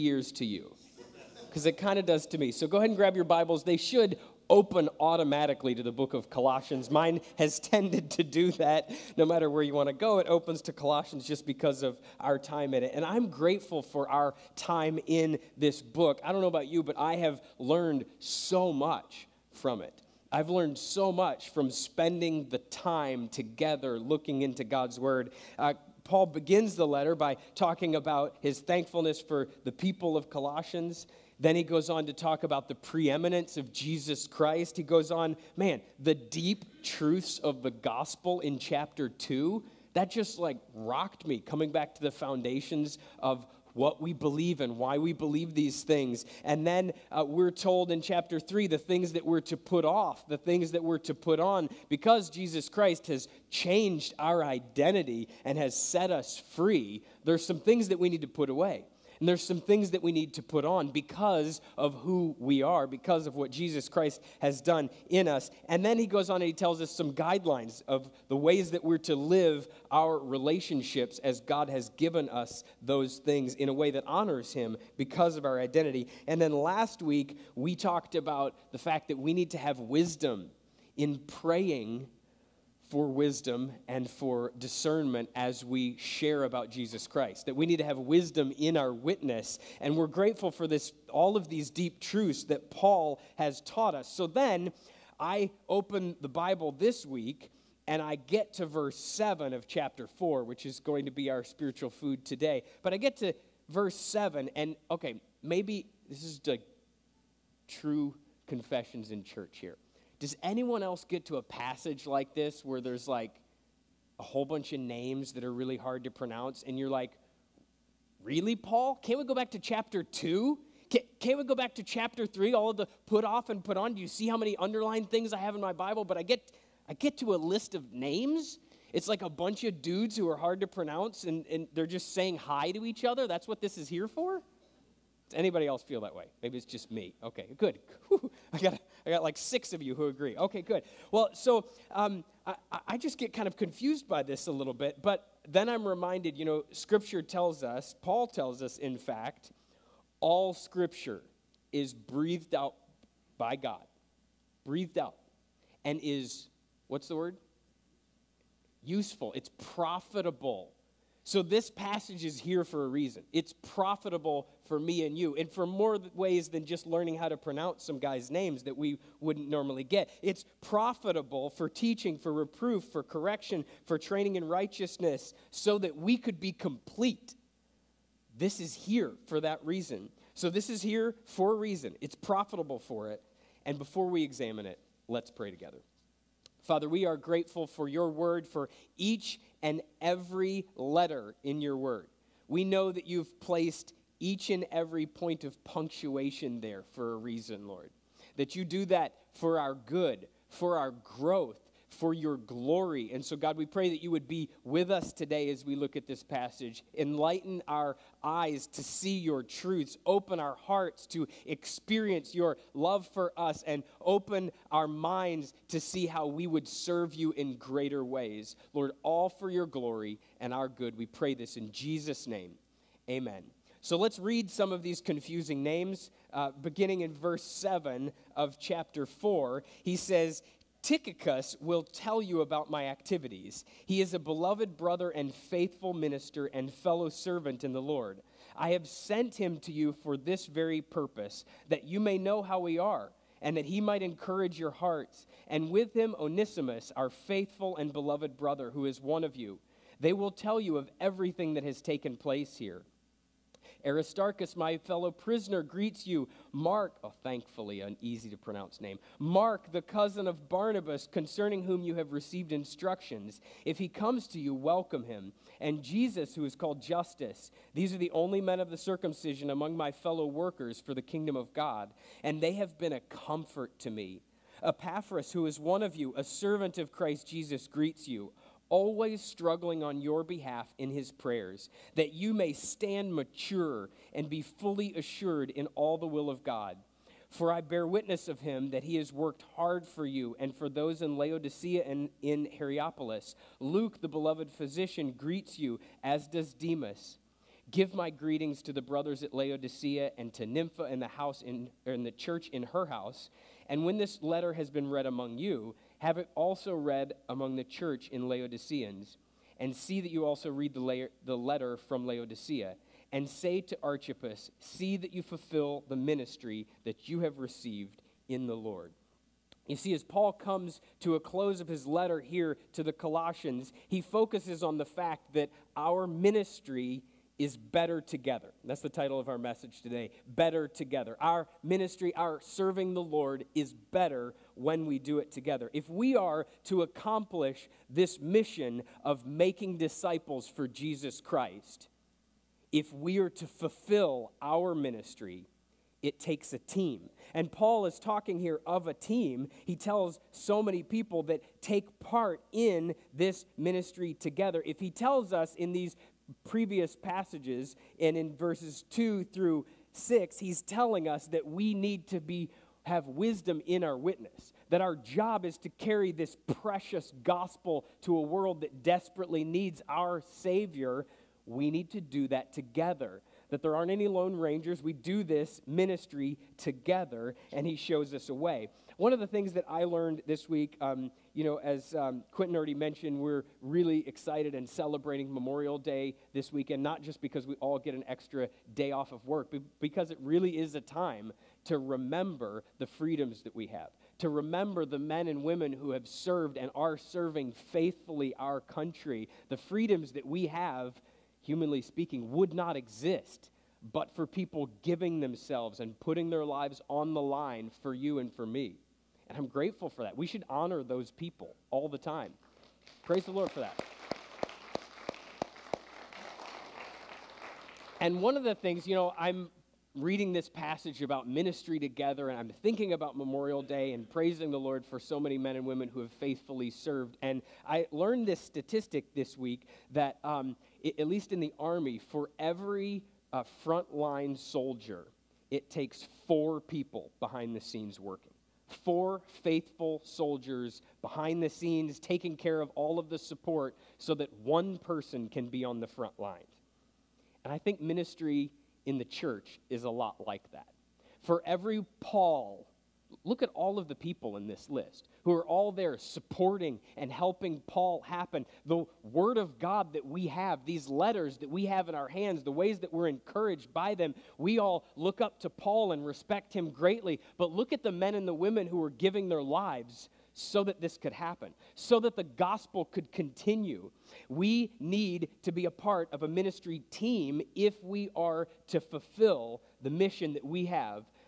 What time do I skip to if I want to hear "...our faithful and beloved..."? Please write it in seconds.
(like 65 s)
246 s.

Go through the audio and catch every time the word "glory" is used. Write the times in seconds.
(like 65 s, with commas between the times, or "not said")
202 s, 219 s.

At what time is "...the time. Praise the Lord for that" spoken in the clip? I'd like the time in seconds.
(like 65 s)
411 s.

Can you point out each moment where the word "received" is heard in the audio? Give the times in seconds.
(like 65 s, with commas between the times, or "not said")
262 s, 317 s.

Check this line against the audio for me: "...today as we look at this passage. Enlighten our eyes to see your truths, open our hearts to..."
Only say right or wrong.
right.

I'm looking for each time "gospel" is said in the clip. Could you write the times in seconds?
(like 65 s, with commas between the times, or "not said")
37 s, 367 s, 472 s.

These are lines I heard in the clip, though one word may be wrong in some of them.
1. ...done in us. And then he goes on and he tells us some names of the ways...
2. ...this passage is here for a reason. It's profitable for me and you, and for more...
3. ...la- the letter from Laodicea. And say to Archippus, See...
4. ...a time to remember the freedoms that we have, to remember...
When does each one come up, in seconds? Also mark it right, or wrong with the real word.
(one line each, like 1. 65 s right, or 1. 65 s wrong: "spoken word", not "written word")
1. 64 s wrong: "guidelines", not "names"
2. 161 s right
3. 310 s right
4. 390 s right.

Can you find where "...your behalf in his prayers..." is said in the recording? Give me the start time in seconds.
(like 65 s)
279 s.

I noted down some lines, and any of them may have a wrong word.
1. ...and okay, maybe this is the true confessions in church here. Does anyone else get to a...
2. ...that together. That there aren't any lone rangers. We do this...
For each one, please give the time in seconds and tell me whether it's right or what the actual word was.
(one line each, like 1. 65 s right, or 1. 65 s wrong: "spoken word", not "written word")
1. 104 s right
2. 372 s right.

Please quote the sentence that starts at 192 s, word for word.
We know that you've placed each and every point of punctuation there for a reason, Lord.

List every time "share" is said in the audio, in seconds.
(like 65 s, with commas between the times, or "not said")
85 s.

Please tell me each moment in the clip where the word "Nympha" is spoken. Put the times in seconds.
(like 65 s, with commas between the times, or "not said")
300 s.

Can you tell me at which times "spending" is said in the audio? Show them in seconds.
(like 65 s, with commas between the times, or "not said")
21 s.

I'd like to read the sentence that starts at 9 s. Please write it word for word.
No matter where you want to go, it opens to Colossians just because of our time in it.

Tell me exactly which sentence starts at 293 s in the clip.
Luke, the beloved physician, greets you, as does Demas.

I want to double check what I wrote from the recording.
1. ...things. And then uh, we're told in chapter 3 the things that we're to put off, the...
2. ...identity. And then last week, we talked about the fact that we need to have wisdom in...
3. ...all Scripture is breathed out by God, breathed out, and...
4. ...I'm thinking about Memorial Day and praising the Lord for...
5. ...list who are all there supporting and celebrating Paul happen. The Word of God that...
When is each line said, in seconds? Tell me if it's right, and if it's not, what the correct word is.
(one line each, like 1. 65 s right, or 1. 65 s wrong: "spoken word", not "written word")
1. 45 s right
2. 75 s right
3. 150 s right
4. 422 s right
5. 454 s wrong: "helping", not "celebrating".